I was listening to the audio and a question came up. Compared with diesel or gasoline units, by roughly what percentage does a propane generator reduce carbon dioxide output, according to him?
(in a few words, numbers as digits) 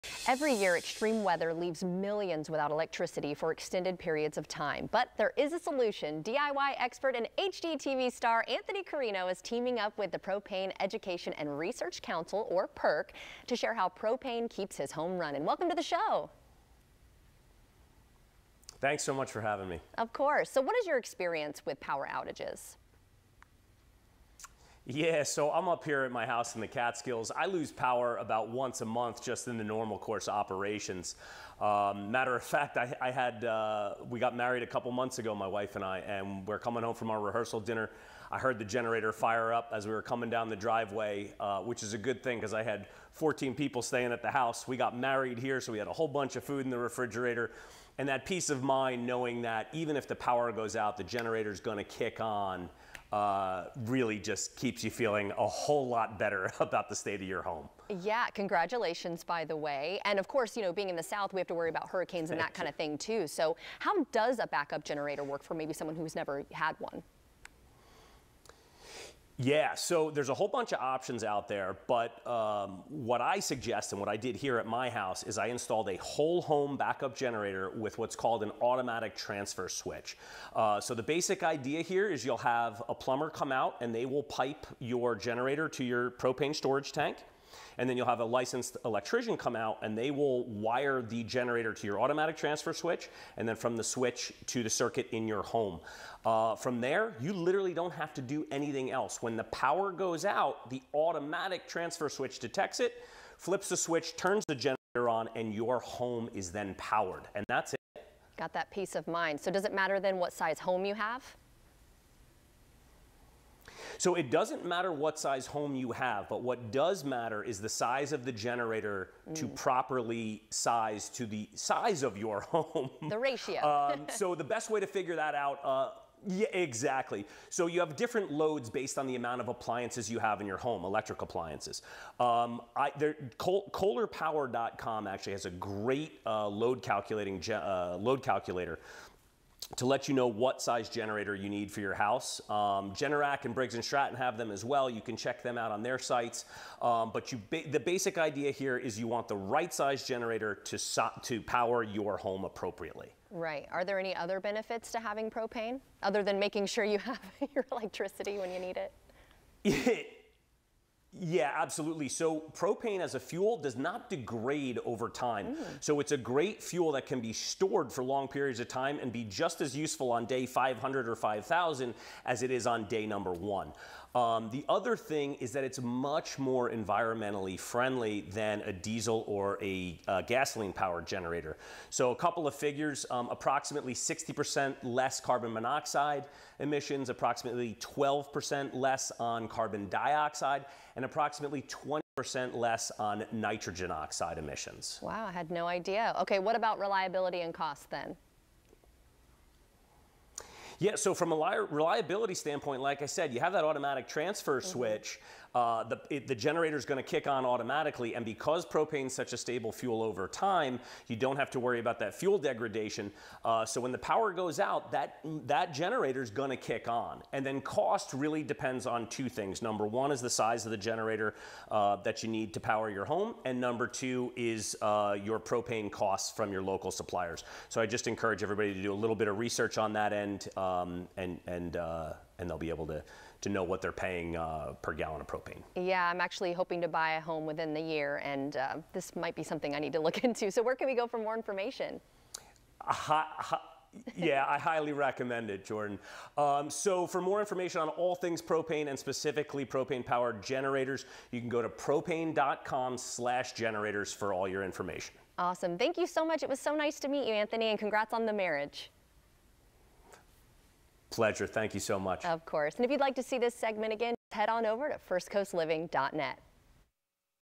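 12%.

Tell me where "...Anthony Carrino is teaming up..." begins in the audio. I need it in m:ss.
0:08.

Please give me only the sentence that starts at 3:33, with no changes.
Uh, so when the power goes out, that, that generator is going to kick on.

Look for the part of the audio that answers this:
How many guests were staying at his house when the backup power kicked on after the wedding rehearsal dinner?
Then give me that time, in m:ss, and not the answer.
0:43.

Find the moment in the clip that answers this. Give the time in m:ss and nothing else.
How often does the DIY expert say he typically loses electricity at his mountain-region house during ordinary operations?
0:28.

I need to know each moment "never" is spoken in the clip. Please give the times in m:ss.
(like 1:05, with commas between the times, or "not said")
1:06.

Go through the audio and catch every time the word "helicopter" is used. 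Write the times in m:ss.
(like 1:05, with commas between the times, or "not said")
not said.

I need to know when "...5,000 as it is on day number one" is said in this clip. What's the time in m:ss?
2:51.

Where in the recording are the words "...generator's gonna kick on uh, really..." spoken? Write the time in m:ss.
0:51.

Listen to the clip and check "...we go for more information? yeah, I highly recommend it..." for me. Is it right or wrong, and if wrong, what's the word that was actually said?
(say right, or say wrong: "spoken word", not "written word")
right.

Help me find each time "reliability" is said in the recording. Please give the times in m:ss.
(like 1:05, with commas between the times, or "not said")
3:16, 3:21.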